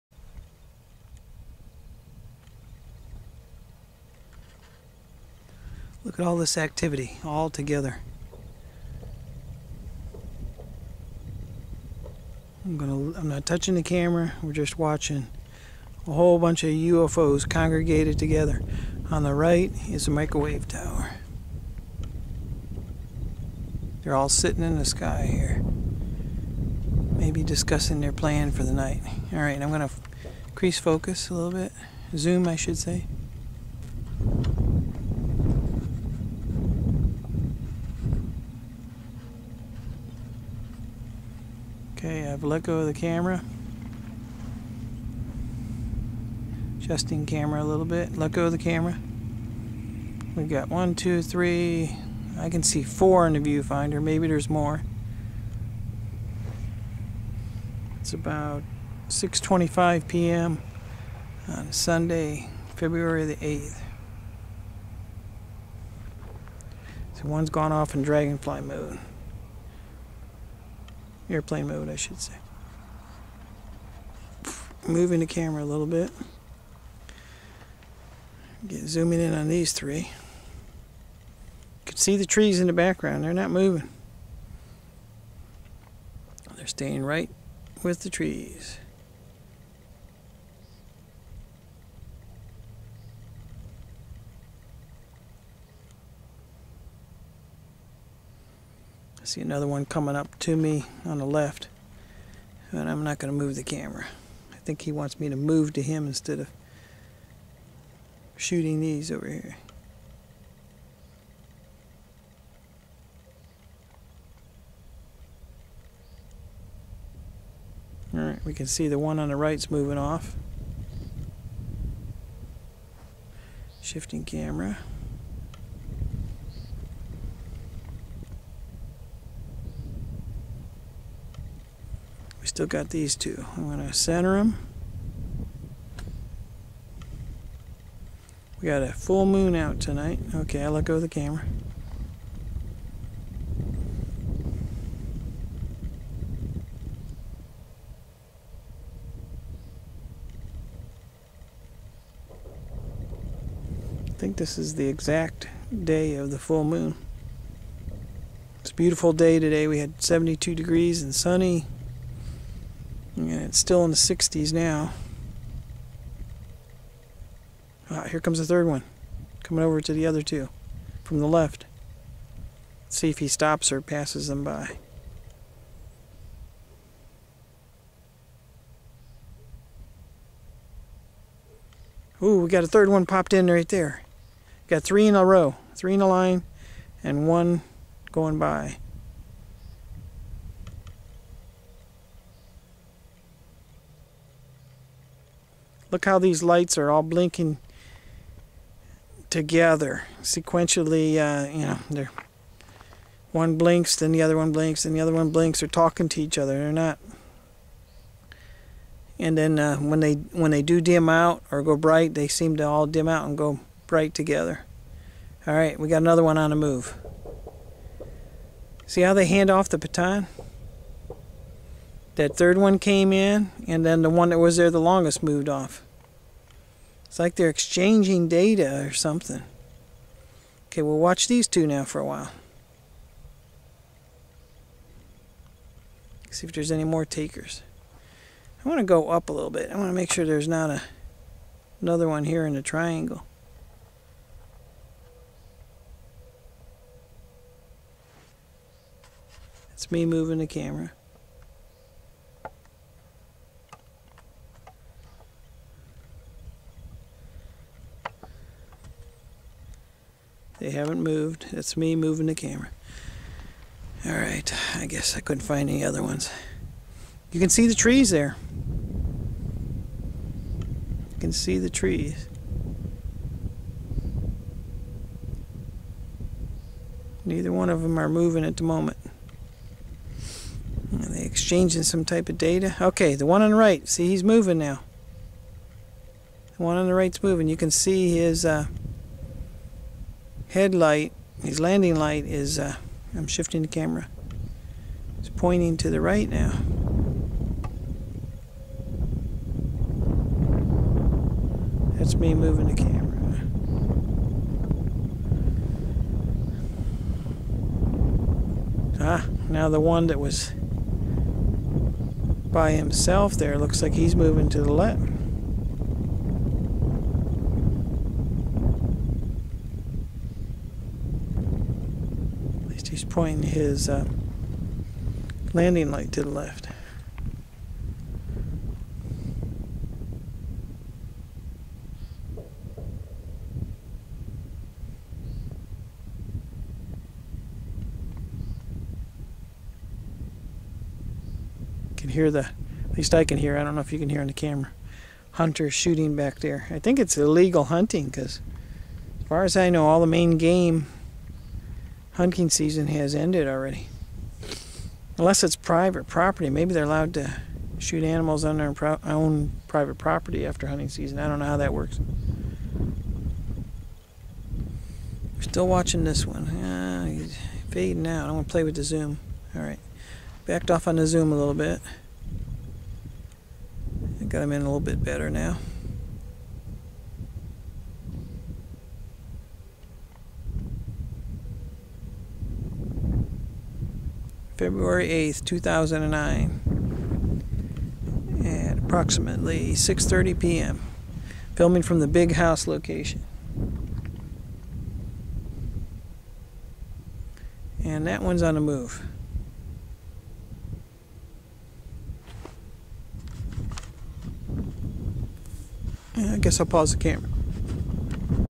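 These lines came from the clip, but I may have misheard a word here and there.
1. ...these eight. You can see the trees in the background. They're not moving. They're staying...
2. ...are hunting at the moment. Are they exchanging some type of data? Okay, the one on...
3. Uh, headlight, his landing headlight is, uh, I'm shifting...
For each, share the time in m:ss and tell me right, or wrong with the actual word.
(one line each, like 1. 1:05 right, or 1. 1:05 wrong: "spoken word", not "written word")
1. 1:19 wrong: "three", not "eight"
2. 4:37 wrong: "moving", not "hunting"
3. 4:48 wrong: "light", not "headlight".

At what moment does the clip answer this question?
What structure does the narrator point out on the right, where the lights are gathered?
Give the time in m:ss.
0:20.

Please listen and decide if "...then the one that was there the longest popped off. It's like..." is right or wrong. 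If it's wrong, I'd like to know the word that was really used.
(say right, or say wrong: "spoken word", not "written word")
wrong: "moved", not "popped".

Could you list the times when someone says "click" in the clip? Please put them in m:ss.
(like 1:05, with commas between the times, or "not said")
not said.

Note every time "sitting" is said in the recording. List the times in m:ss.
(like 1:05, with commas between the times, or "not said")
0:24.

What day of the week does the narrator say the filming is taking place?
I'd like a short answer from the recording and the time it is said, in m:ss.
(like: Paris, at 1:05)
Sunday, at 1:01.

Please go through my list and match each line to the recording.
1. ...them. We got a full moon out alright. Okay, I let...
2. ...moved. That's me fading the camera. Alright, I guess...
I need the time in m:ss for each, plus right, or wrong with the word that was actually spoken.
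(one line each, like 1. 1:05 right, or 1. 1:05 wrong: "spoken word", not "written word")
1. 2:14 wrong: "tonight", not "alright"
2. 4:21 wrong: "moving", not "fading".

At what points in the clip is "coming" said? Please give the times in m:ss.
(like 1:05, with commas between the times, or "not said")
1:39, 2:49.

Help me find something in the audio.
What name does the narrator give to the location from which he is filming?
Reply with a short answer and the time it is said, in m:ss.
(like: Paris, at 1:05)
the Big House, at 6:32.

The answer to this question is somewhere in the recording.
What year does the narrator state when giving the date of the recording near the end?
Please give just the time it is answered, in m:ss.
6:25.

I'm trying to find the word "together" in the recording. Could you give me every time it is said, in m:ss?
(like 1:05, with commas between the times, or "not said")
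0:07, 0:18, 3:19, 3:34.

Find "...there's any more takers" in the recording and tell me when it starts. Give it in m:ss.
3:56.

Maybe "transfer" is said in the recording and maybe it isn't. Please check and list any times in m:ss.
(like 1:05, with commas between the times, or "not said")
not said.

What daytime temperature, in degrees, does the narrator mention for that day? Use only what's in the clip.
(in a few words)
72.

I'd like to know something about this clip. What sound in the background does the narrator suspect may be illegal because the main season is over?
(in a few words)
hunter shooting.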